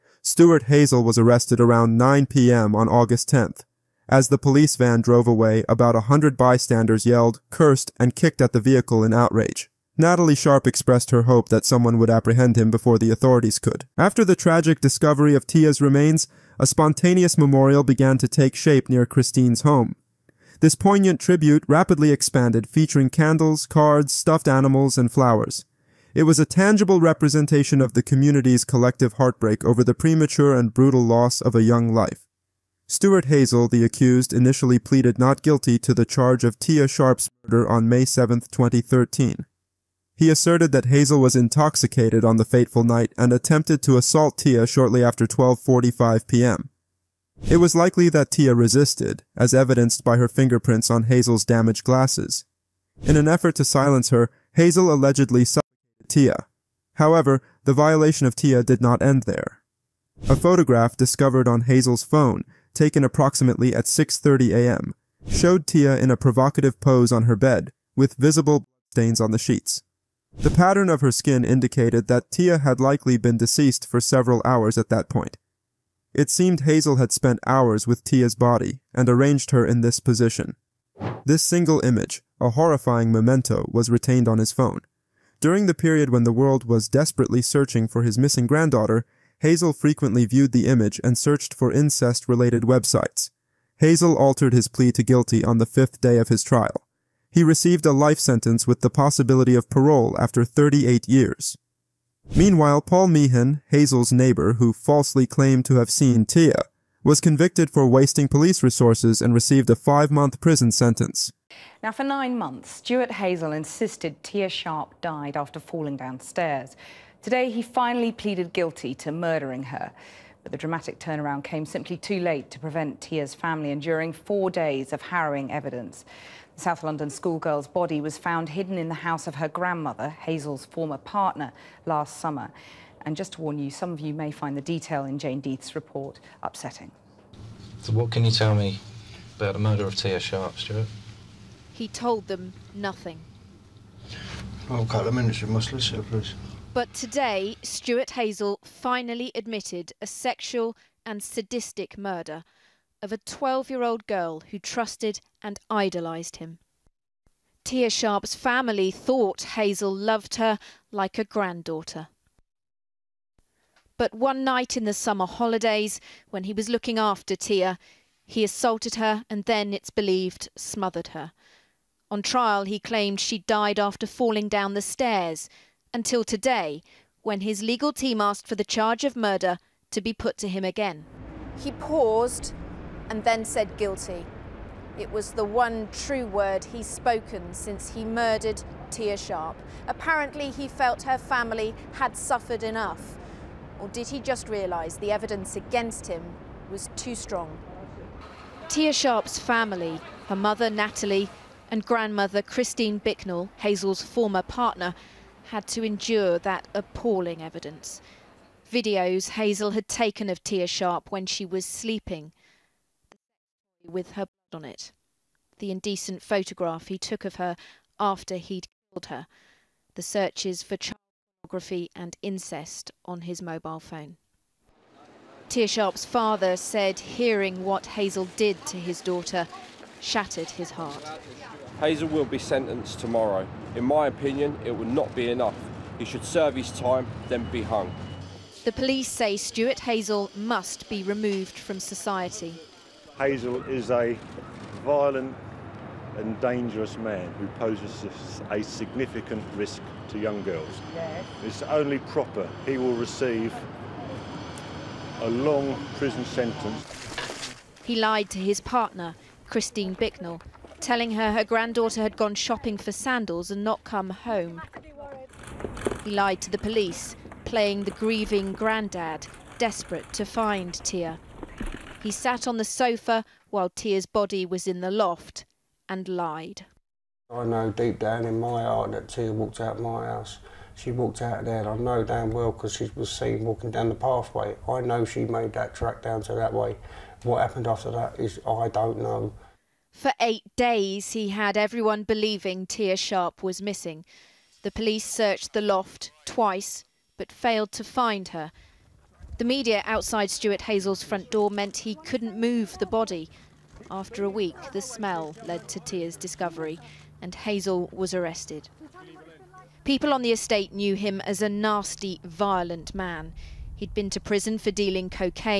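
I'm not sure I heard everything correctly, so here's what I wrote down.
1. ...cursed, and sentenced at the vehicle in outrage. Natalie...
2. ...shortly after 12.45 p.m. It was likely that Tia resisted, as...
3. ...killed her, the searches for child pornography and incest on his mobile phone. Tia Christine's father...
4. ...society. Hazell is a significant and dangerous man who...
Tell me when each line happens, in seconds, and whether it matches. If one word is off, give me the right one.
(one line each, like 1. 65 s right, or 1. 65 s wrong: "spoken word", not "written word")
1. 7 s wrong: "kicked", not "sentenced"
2. 44 s right
3. 218 s wrong: "Sharp", not "Christine"
4. 241 s wrong: "violent", not "significant".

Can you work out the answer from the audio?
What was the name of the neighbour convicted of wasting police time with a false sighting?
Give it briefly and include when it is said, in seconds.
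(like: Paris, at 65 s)
Paul Meehan, at 102 s.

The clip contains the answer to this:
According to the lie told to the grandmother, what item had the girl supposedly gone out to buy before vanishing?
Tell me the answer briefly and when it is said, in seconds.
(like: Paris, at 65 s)
Sandals, at 262 s.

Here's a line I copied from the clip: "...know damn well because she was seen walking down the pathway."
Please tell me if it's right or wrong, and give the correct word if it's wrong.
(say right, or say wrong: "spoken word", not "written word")
right.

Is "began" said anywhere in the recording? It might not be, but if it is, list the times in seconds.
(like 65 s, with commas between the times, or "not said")
17 s.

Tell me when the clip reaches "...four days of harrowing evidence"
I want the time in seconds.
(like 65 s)
124 s.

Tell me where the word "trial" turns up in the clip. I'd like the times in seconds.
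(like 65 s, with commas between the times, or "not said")
96 s, 172 s.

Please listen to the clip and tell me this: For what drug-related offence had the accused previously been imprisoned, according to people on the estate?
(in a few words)
Dealing cocaine.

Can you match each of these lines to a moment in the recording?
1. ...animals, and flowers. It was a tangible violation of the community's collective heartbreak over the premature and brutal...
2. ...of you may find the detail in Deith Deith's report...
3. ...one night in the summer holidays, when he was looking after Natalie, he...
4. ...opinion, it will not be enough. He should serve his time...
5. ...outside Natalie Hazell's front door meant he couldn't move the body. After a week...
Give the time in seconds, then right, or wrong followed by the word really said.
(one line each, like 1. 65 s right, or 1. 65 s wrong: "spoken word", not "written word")
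1. 24 s wrong: "representation", not "violation"
2. 133 s wrong: "Jane", not "Deith"
3. 164 s wrong: "Tia", not "Natalie"
4. 234 s right
5. 299 s wrong: "Stuart", not "Natalie".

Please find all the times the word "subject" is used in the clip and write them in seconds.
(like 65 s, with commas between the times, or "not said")
not said.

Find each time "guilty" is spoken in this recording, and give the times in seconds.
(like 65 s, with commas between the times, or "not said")
35 s, 95 s, 118 s, 183 s.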